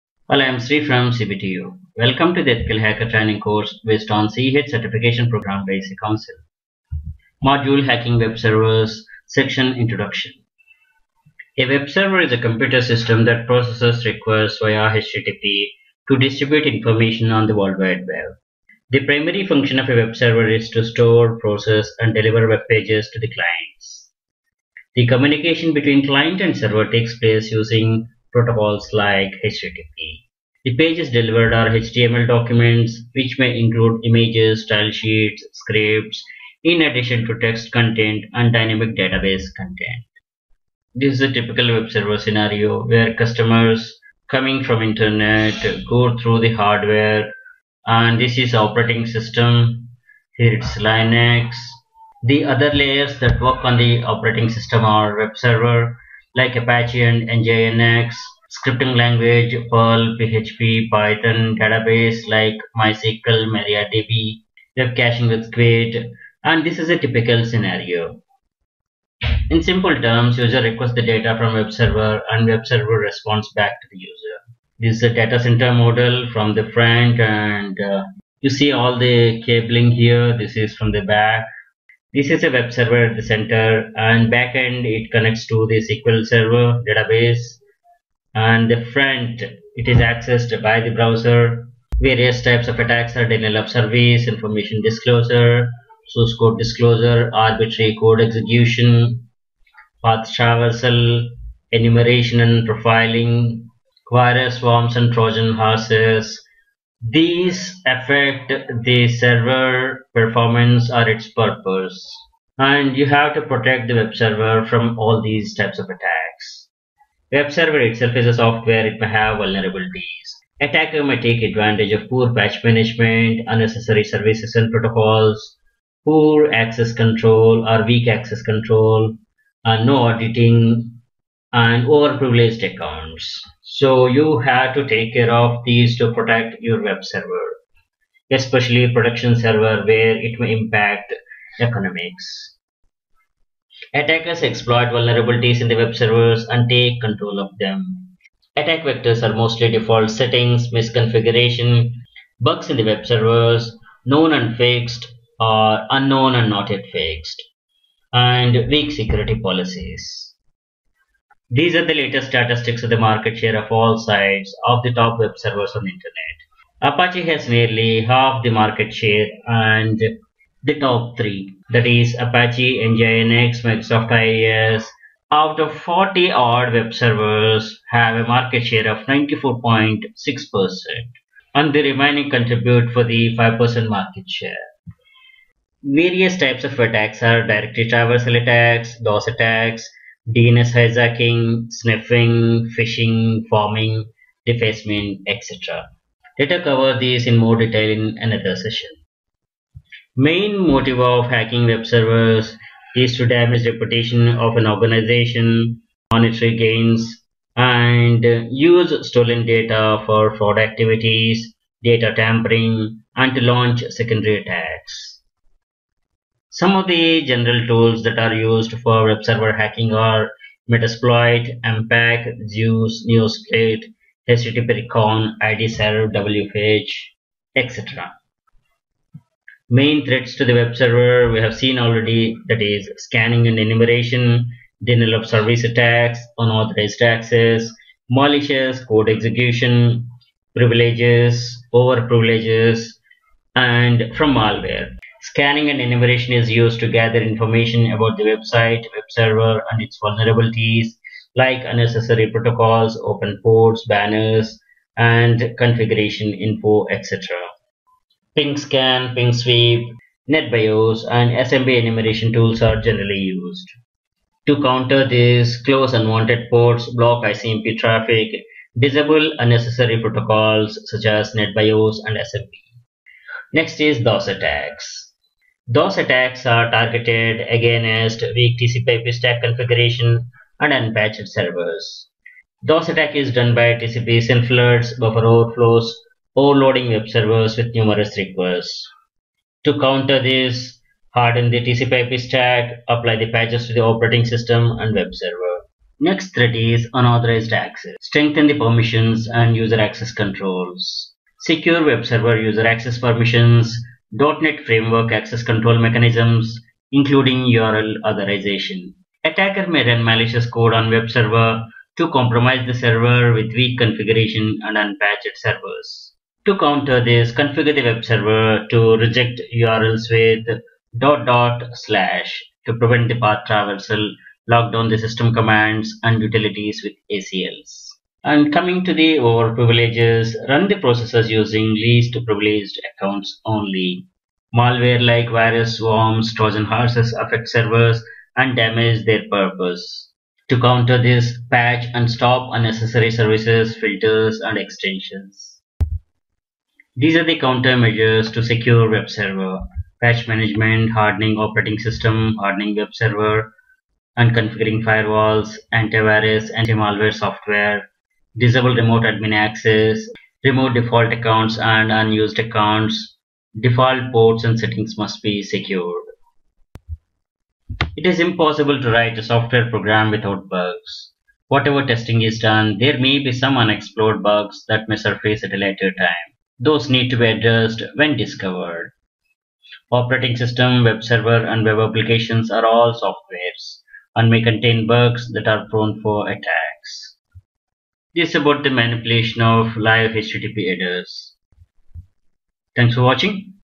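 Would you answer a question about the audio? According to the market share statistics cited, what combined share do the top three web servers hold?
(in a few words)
94.6%.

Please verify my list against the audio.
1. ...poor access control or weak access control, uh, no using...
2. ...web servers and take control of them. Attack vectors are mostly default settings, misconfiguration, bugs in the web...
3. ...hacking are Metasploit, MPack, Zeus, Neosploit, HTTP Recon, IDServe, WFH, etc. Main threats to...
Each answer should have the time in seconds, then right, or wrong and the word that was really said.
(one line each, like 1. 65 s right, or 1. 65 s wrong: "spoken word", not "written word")
1. 126 s wrong: "auditing", not "using"
2. 145 s right
3. 219 s right.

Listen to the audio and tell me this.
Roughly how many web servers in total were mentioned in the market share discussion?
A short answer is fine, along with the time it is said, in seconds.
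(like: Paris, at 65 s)
40, at 175 s.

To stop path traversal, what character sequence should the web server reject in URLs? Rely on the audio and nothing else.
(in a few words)
../ (dot dot slash).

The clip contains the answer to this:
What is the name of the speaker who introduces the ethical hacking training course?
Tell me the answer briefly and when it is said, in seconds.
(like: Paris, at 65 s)
Sri, at 0 s.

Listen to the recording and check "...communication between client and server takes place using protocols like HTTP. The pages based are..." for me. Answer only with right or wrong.
wrong.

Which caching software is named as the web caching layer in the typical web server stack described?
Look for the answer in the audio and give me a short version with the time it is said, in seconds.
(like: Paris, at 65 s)
Squid, at 65 s.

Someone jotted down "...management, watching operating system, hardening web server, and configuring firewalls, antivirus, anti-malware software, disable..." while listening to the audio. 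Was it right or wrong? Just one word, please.
wrong.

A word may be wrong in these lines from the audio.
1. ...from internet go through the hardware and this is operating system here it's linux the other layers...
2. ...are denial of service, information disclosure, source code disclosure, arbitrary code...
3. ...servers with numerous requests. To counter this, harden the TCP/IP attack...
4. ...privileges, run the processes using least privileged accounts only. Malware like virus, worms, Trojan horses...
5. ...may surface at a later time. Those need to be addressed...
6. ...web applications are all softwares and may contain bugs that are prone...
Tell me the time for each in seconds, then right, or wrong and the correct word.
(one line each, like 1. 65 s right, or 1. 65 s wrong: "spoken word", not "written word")
1. 44 s right
2. 93 s right
3. 287 s wrong: "stack", not "attack"
4. 329 s right
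5. 374 s right
6. 381 s right.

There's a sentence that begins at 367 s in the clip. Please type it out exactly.
It is impossible to write a software program without bugs.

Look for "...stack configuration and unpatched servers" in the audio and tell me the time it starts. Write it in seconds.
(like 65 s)
279 s.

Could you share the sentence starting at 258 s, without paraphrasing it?
Ping scan, ping sweep, NetBIOS, and SMB enumeration tools are generally used.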